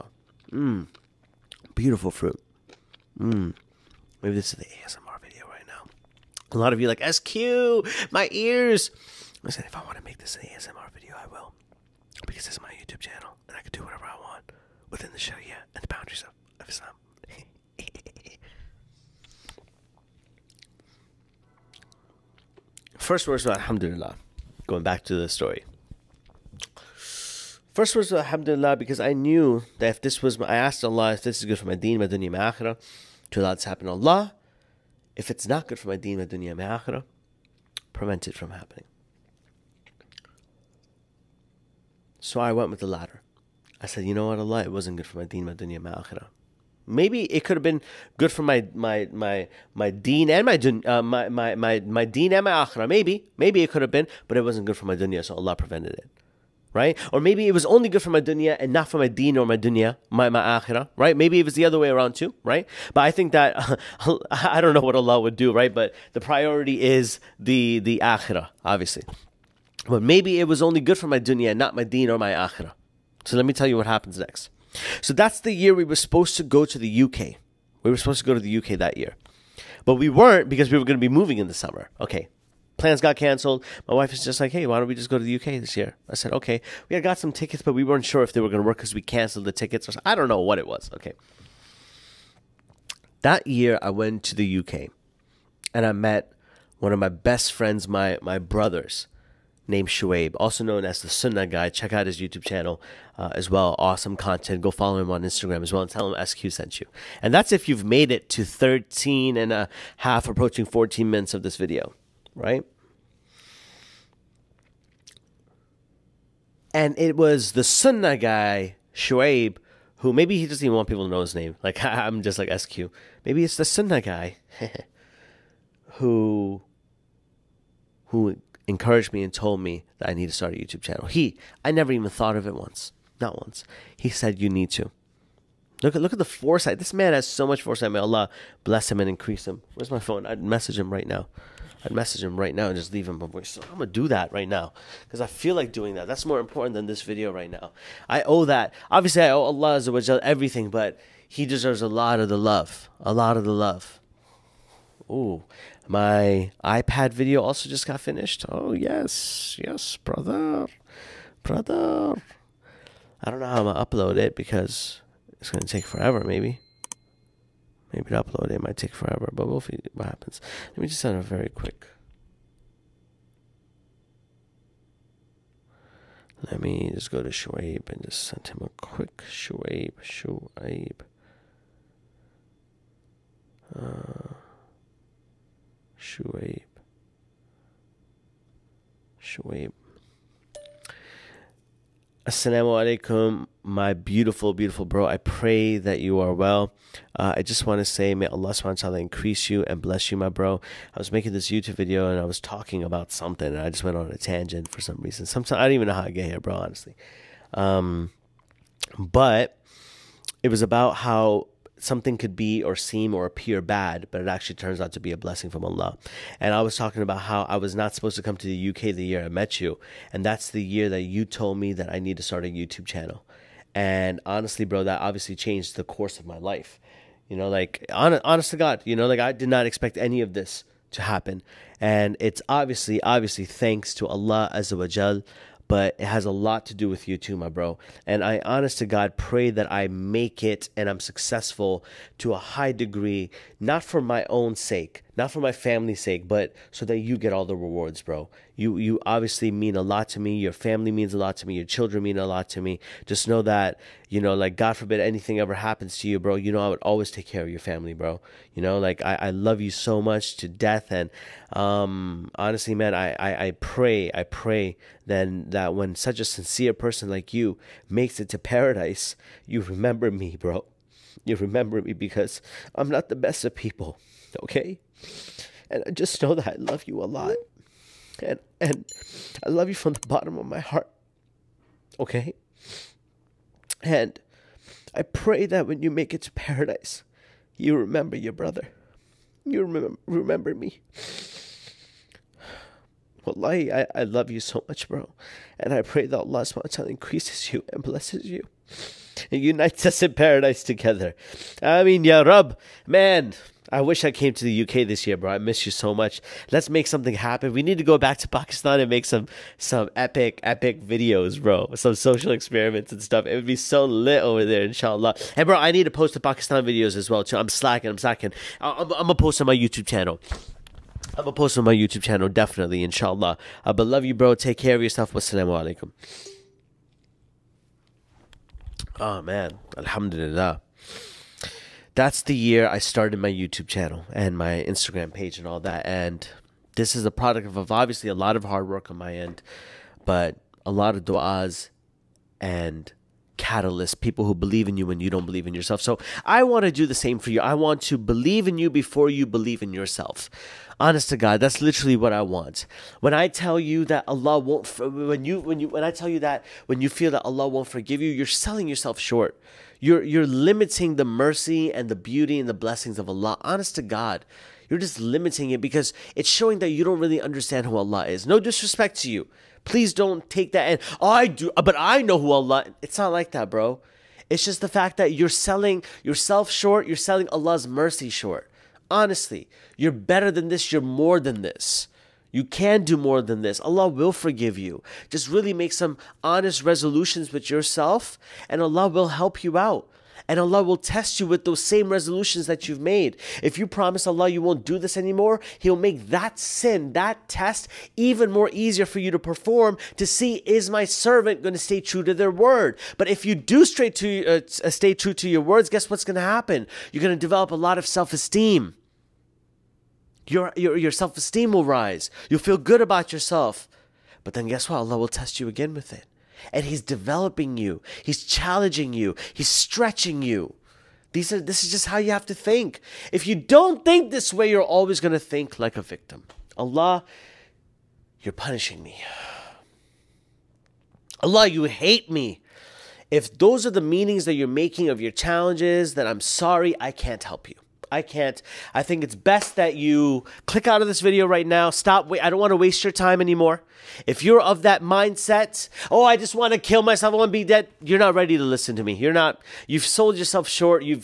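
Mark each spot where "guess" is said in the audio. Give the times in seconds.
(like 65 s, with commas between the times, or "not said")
405 s, 414 s.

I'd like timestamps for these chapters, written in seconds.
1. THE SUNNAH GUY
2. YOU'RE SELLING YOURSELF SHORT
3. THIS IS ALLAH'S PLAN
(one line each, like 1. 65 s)
1. 99 s
2. 332 s
3. 26 s.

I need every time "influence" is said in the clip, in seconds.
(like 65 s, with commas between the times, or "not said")
not said.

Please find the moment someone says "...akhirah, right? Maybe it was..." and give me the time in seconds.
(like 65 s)
60 s.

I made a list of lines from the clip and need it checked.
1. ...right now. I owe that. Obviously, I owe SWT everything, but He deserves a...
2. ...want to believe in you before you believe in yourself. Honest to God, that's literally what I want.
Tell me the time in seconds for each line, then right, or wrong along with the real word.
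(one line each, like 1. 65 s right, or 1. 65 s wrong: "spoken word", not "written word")
1. 147 s wrong: "Allah", not "SWT"
2. 347 s right.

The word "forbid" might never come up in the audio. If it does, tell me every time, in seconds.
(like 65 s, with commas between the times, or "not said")
254 s.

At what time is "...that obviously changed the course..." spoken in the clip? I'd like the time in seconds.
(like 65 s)
224 s.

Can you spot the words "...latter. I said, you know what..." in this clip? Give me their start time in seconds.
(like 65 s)
42 s.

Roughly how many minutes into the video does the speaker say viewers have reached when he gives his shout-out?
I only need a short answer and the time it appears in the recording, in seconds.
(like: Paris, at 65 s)
14, at 110 s.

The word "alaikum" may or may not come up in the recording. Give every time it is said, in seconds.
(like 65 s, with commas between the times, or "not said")
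192 s, 325 s.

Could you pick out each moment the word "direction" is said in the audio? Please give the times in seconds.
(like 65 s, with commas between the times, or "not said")
not said.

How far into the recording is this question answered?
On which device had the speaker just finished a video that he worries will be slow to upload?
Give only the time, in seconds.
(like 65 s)
156 s.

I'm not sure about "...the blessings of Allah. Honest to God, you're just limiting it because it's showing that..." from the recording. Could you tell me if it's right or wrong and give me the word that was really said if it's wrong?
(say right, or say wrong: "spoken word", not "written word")
right.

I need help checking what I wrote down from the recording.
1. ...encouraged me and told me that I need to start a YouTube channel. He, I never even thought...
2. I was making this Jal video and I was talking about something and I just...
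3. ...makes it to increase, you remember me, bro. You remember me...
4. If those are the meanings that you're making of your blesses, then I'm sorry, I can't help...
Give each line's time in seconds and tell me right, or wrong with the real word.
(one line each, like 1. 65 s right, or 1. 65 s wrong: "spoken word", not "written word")
1. 128 s right
2. 200 s wrong: "YouTube", not "Jal"
3. 267 s wrong: "paradise", not "increase"
4. 433 s wrong: "challenges", not "blesses".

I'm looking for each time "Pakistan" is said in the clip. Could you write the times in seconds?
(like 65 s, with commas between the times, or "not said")
308 s, 316 s.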